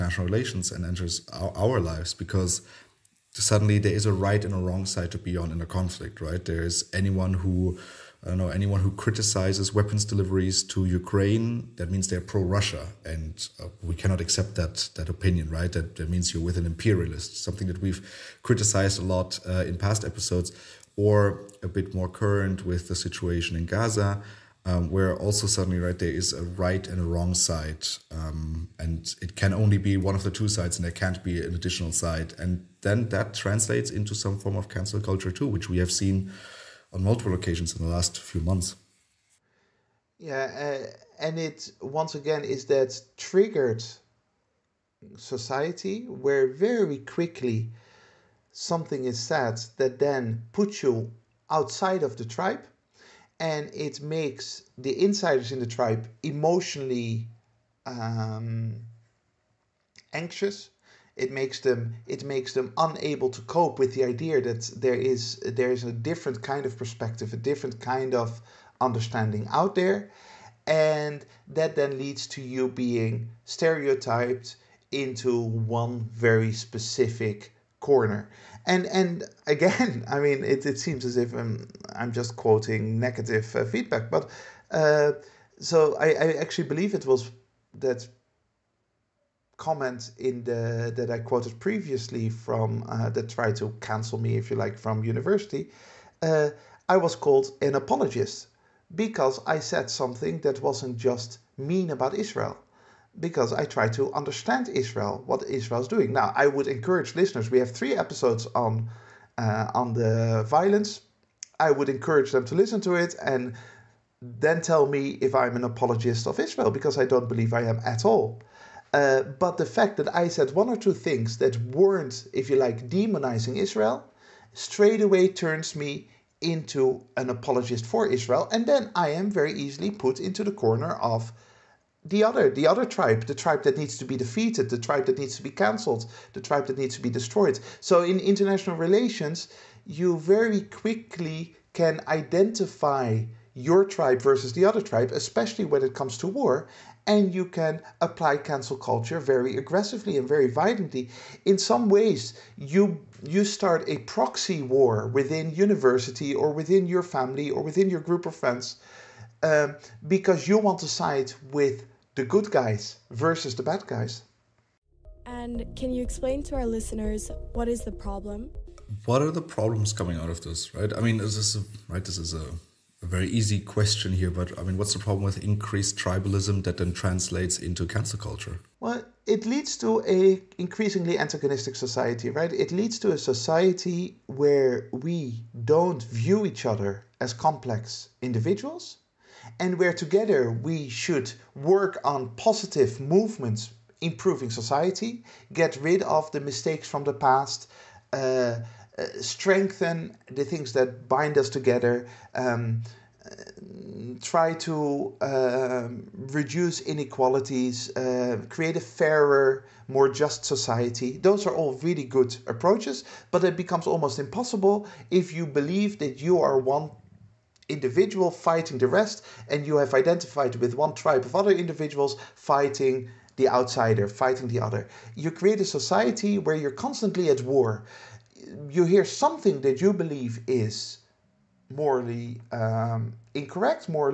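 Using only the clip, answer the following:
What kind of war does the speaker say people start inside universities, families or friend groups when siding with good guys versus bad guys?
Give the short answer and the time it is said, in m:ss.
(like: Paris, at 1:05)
proxy war, at 2:33.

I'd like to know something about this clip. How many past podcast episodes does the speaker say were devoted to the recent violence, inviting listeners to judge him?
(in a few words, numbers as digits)
3.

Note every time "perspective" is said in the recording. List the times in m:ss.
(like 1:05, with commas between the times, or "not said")
1:06.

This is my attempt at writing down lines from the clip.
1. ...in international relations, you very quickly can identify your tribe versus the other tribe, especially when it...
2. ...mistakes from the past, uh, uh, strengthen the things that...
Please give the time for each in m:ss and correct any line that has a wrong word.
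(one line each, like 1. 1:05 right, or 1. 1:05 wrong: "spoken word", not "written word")
1. 2:18 right
2. 3:16 right.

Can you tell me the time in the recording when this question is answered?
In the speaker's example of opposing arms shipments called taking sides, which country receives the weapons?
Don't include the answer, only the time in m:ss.
0:10.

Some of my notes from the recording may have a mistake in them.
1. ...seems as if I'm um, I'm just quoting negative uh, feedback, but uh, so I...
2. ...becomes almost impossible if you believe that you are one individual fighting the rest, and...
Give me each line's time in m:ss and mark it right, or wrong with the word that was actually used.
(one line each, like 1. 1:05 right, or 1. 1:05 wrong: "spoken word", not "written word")
1. 1:20 right
2. 3:33 right.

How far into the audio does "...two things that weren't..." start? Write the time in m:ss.
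2:00.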